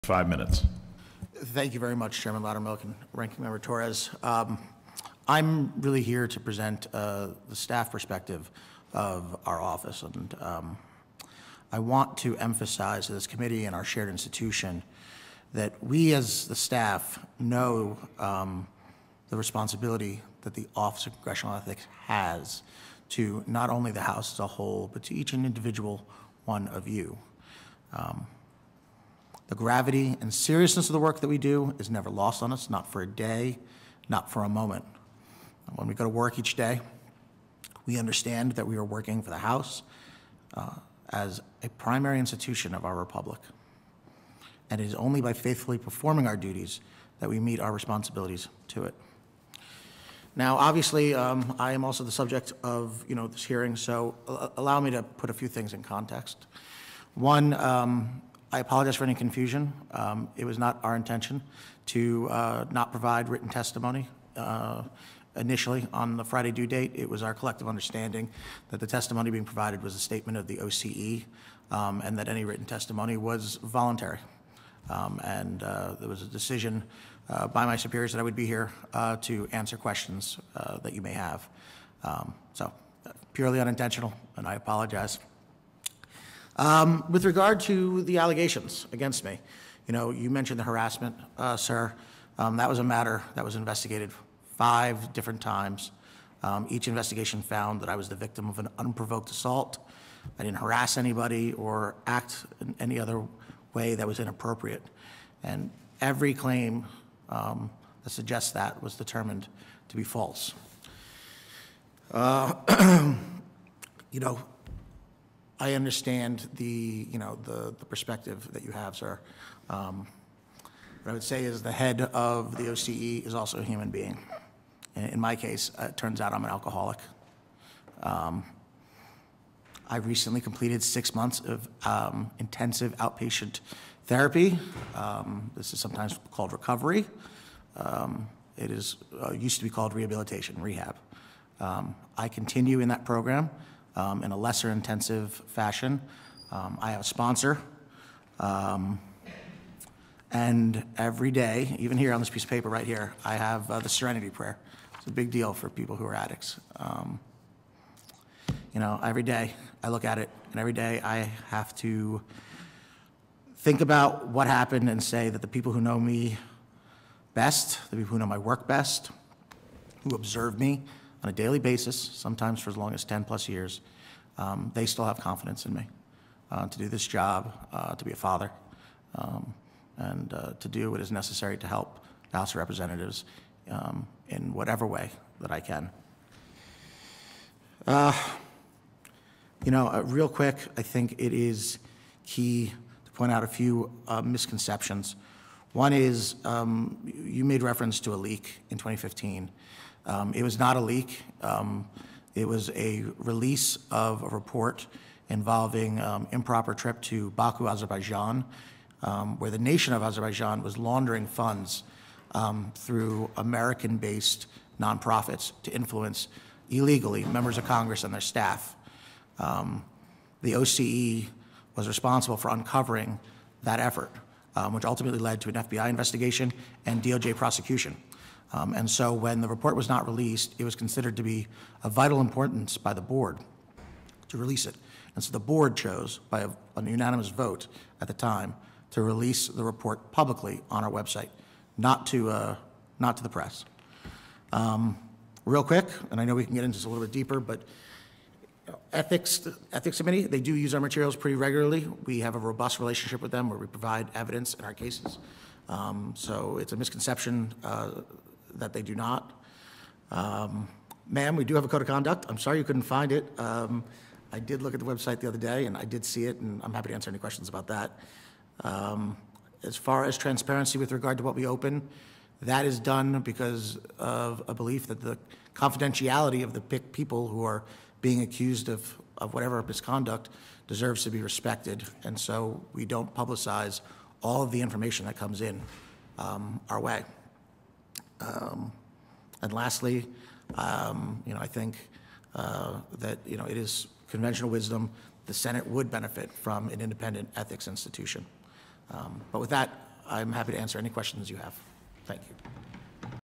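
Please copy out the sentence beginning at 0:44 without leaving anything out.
And it is only by faithfully performing our duties that we meet our responsibilities to it.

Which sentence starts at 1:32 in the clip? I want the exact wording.
Um, that was a matter that was investigated five different times.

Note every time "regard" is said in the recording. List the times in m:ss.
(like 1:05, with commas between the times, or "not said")
1:27, 4:30.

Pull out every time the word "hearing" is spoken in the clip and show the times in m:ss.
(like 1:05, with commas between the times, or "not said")
0:53.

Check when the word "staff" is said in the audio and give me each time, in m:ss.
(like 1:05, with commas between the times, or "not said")
0:07, 0:16, 3:38.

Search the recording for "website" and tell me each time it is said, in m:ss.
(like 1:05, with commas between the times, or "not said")
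4:00, 4:24.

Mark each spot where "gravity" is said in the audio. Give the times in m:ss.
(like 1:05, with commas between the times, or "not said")
0:29.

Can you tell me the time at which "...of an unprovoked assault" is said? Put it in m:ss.
1:38.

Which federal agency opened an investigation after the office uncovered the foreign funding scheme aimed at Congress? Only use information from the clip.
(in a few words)
FBI.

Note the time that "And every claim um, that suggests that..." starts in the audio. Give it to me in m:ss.
1:45.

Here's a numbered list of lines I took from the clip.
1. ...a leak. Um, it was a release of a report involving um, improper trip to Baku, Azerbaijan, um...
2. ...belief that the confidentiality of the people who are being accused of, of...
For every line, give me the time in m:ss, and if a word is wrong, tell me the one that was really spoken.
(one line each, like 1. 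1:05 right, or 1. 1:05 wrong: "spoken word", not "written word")
1. 3:20 right
2. 4:34 right.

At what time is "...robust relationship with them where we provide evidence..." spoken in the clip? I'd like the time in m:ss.
4:12.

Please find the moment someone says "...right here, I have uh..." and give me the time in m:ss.
2:32.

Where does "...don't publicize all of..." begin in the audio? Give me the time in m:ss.
4:42.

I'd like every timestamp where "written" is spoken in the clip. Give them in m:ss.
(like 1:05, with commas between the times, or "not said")
1:03, 1:12.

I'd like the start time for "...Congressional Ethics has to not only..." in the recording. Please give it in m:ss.
0:21.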